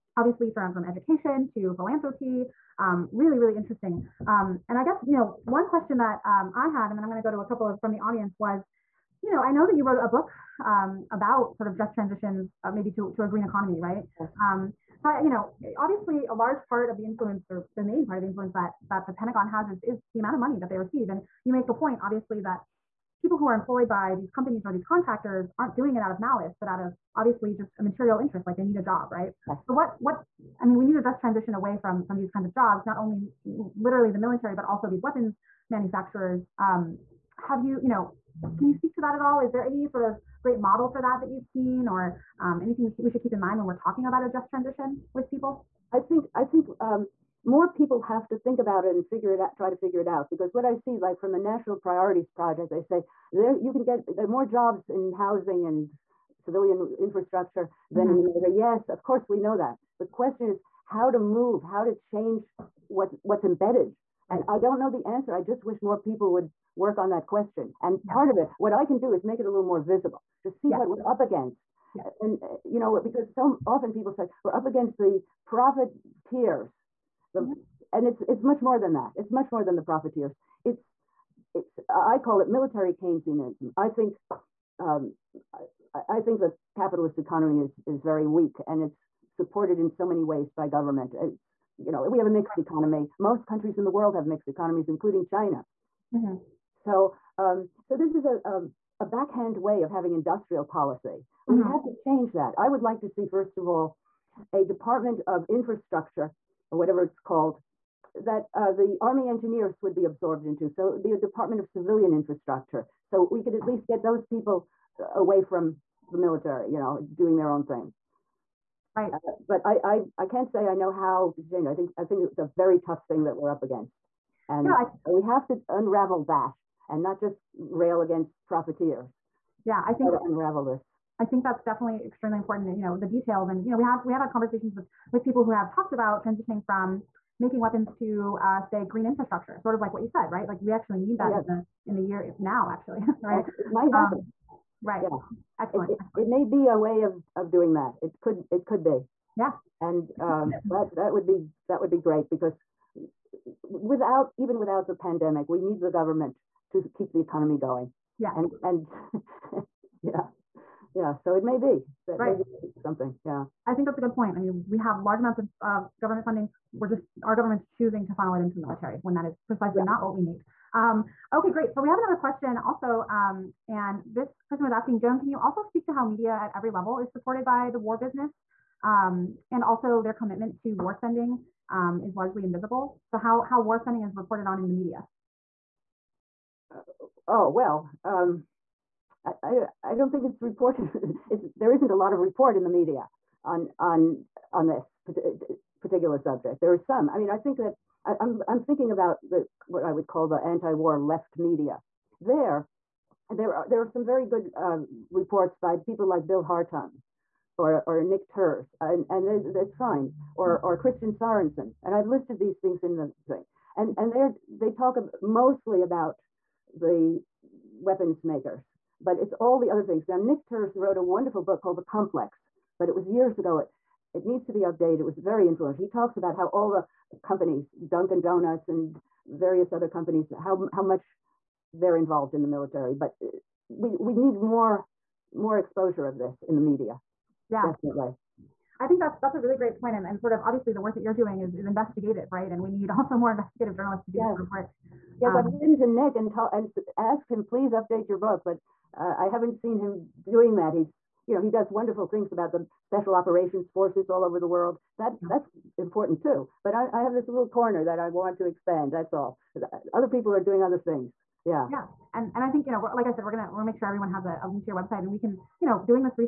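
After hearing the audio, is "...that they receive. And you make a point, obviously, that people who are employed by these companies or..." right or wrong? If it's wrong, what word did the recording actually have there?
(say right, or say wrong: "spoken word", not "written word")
right.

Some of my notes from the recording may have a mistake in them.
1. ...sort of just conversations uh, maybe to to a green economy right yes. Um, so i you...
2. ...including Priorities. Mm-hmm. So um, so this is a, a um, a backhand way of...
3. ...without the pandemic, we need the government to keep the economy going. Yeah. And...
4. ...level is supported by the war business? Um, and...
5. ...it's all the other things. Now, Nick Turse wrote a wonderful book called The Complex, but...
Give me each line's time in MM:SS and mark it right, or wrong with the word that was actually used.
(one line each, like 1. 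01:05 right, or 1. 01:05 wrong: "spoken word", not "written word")
1. 00:11 wrong: "transitions", not "conversations"
2. 01:34 wrong: "China", not "Priorities"
3. 02:34 right
4. 02:56 right
5. 03:39 right.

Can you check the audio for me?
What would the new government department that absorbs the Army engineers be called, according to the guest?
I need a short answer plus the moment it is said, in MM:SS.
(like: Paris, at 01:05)
Department of Civilian Infrastructure, at 01:51.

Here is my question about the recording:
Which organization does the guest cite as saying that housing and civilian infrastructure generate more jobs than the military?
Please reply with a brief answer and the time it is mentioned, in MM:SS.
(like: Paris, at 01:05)
National Priorities Project, at 00:51.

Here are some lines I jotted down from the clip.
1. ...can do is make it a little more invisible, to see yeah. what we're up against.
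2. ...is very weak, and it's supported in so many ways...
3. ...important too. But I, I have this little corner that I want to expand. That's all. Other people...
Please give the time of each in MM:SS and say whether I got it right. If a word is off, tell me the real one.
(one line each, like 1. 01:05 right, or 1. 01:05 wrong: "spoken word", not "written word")
1. 01:08 wrong: "visible", not "invisible"
2. 01:27 right
3. 04:15 right.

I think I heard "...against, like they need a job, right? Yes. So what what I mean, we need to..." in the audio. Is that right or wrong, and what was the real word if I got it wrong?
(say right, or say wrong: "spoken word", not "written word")
wrong: "interest", not "against".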